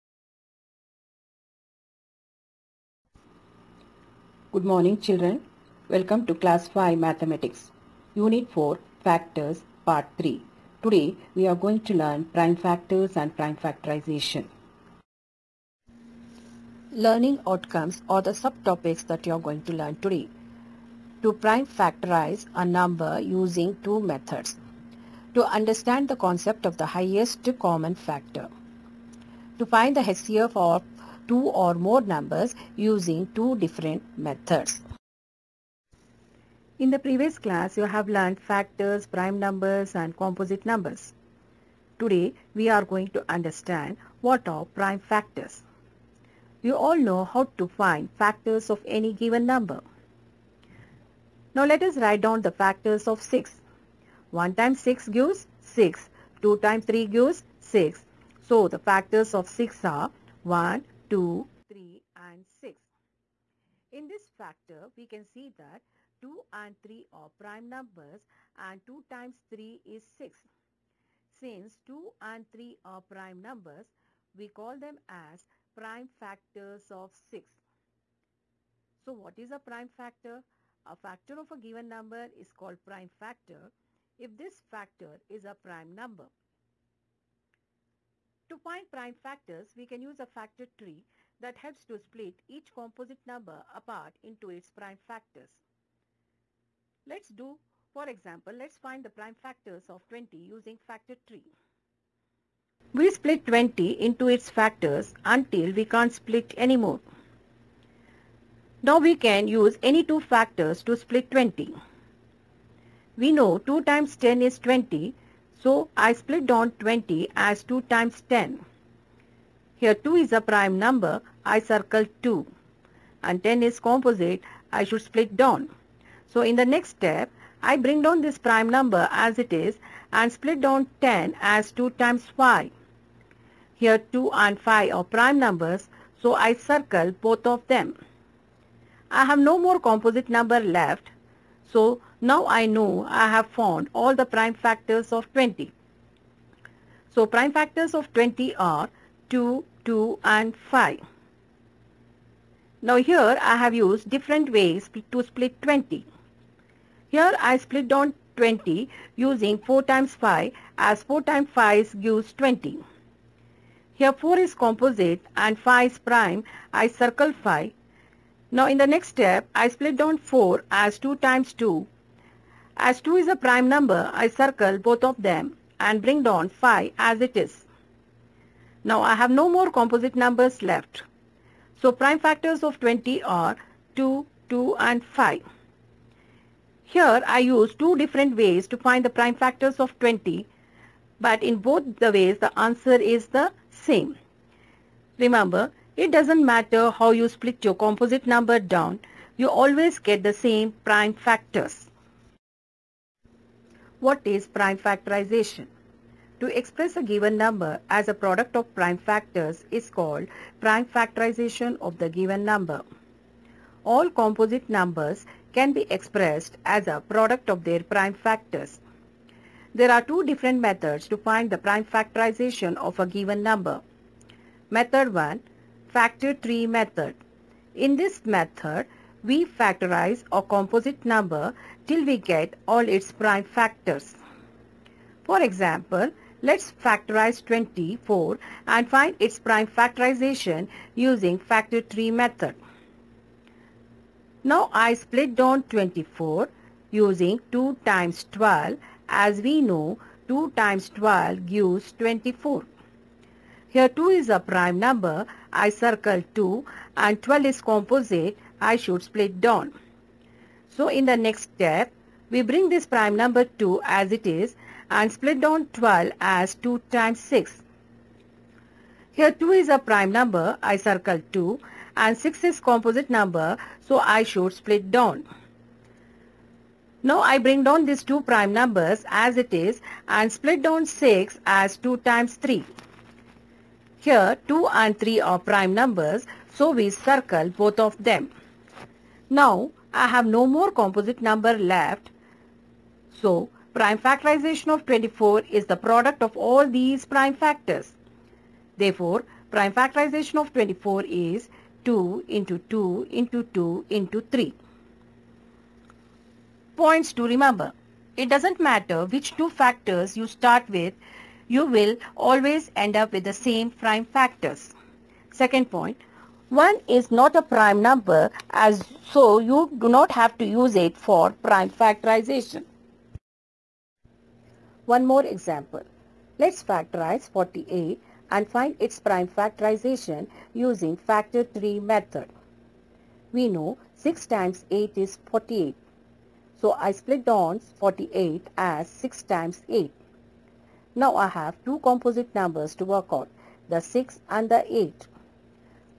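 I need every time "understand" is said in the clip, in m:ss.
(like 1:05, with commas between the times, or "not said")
0:25, 0:43.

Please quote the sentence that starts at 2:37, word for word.
Here I split down 20 using 4 times 5 as 4 times 5 gives 20.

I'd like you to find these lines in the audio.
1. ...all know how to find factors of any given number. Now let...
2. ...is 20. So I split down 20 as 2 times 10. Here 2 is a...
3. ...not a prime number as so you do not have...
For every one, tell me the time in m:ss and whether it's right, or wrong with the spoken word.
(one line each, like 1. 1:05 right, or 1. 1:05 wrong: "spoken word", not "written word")
1. 0:46 right
2. 1:54 right
3. 5:17 right.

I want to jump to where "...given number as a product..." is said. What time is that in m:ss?
3:27.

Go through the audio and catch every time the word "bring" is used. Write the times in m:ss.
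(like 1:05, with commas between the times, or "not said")
2:07, 2:56, 4:22, 4:37.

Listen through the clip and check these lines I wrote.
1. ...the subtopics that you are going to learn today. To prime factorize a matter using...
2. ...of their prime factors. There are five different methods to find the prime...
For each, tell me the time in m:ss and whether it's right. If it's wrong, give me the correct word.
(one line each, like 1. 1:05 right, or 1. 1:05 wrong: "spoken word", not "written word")
1. 0:18 wrong: "number", not "matter"
2. 3:37 wrong: "two", not "five".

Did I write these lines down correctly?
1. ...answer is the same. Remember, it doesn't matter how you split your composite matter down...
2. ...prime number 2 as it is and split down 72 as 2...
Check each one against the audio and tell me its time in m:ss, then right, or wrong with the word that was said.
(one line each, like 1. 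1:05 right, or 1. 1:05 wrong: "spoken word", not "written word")
1. 3:12 wrong: "number", not "matter"
2. 4:22 wrong: "12", not "72".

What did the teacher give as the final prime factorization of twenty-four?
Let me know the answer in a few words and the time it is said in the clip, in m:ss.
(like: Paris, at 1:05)
2 into 2 into 2 into 3, at 5:01.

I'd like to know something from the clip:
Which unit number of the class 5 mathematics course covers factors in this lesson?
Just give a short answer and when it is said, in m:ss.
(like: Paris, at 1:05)
4, at 0:08.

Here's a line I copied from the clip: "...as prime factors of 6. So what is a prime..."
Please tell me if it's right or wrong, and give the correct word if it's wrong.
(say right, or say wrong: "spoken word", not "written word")
right.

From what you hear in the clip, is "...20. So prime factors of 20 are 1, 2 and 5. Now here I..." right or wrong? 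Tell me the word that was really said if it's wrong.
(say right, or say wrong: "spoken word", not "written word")
wrong: "2", not "1".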